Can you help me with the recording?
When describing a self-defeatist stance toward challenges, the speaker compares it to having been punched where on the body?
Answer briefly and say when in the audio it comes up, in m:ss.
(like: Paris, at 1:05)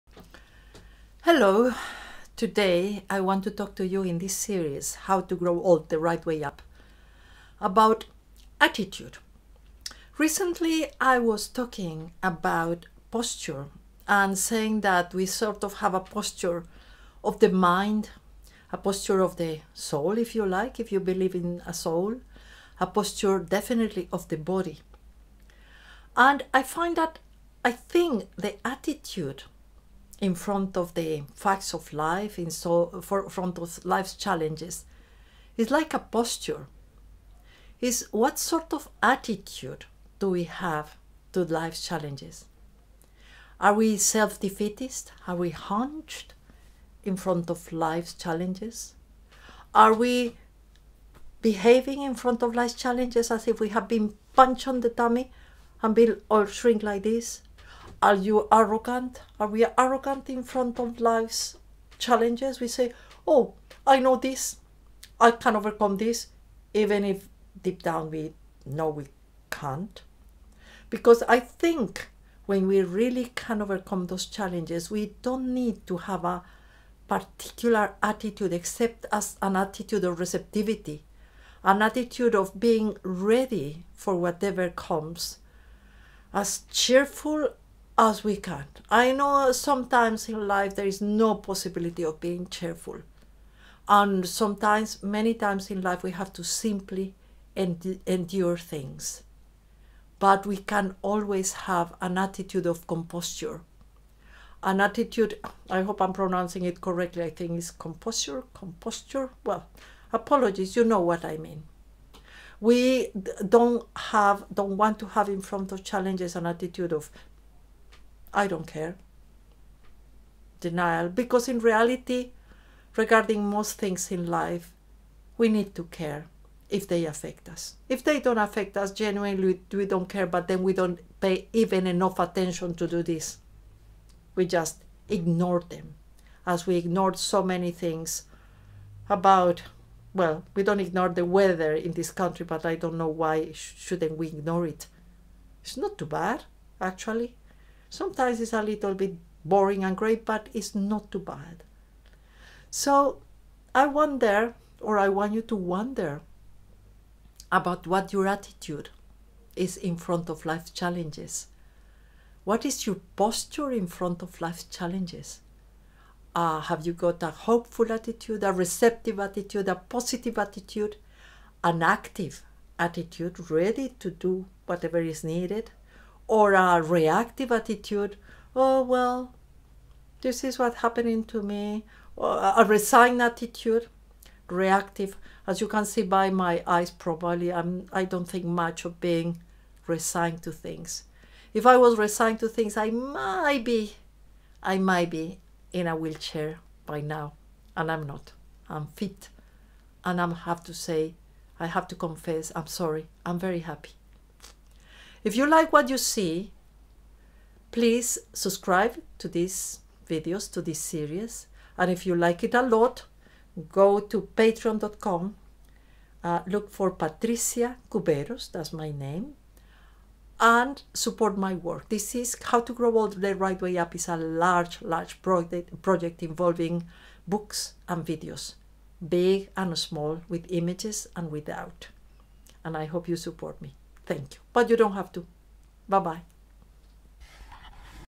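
tummy, at 0:54.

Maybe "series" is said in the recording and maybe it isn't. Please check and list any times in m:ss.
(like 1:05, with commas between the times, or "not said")
0:04, 3:30.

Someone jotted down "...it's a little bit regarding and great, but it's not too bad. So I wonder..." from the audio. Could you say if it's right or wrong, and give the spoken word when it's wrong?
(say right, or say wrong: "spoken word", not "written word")
wrong: "boring", not "regarding".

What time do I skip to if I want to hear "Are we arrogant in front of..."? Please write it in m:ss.
0:59.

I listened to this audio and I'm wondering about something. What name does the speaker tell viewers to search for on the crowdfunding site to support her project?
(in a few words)
Patrissia Cuberos.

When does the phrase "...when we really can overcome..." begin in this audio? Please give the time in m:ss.
1:12.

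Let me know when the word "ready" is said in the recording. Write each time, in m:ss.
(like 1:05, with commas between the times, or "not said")
1:23, 2:53.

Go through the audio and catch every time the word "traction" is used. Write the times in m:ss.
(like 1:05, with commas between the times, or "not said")
not said.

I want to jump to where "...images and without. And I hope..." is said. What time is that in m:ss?
3:50.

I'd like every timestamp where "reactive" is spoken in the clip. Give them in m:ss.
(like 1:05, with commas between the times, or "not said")
2:56, 3:04.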